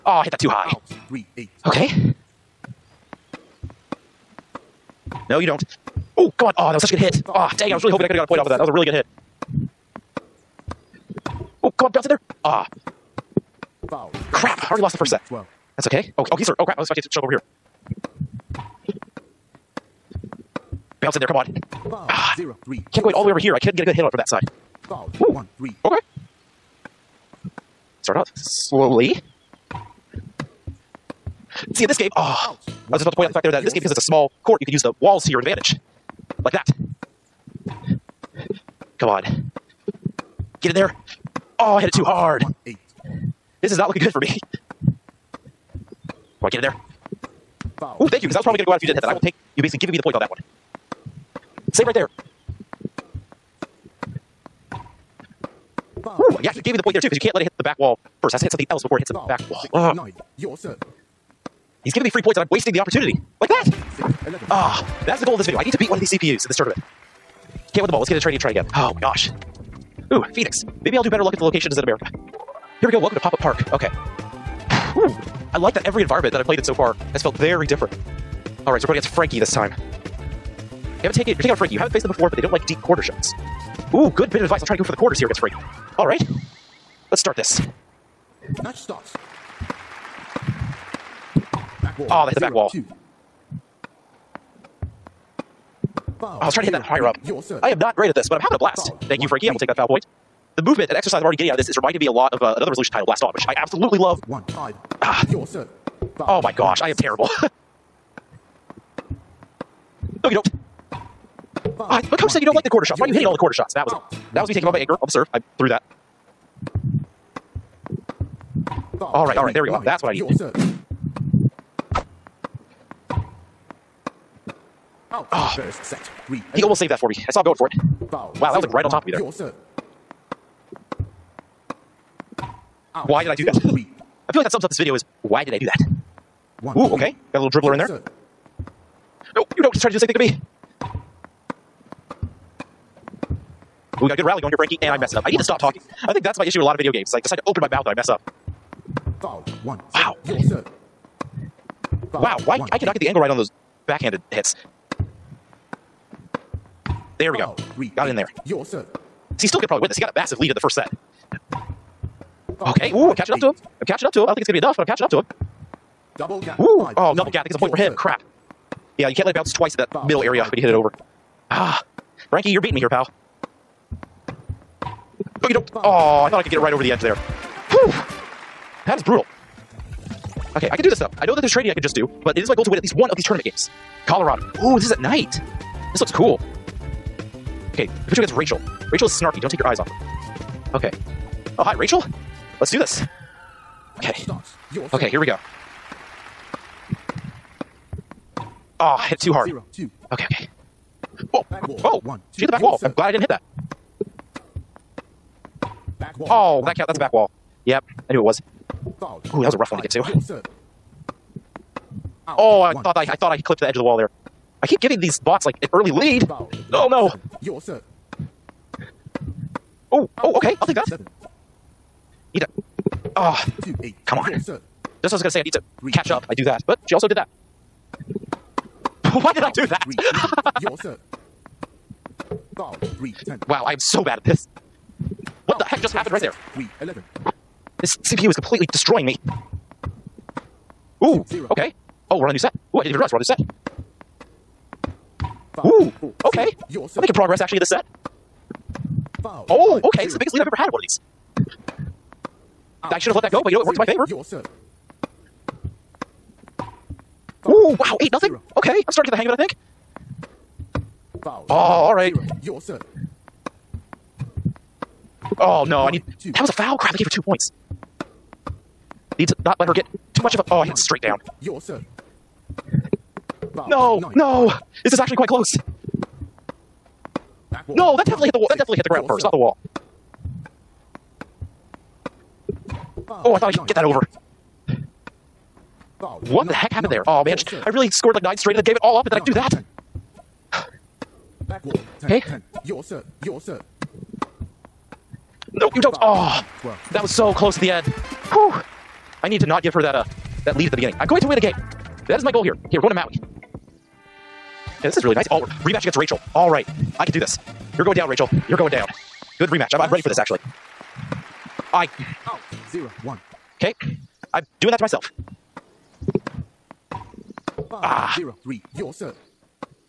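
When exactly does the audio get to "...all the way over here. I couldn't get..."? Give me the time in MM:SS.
00:23.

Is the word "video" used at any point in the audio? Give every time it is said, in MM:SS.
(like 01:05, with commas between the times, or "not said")
01:05, 02:14, 02:26.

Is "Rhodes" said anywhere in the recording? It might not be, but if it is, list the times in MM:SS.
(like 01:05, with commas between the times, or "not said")
not said.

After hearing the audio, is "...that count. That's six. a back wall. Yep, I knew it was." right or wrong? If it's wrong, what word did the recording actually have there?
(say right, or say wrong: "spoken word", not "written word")
wrong: "four", not "six".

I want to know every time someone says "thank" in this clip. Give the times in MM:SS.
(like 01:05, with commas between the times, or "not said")
00:48, 01:39.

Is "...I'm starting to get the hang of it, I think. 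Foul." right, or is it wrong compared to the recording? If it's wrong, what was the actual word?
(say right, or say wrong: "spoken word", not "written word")
right.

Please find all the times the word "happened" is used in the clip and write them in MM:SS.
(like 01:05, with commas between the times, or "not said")
03:55, 04:46.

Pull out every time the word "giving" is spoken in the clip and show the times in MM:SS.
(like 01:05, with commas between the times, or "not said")
00:49, 01:01, 03:34.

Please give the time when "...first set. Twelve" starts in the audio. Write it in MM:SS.
00:14.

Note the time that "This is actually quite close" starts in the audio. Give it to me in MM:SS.
04:34.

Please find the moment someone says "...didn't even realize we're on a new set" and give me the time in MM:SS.
04:02.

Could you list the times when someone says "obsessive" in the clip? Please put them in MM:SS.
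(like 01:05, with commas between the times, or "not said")
not said.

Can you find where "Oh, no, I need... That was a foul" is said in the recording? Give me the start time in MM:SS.
04:25.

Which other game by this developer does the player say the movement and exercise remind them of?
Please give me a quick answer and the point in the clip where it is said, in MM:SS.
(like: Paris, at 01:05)
Blaston, at 01:43.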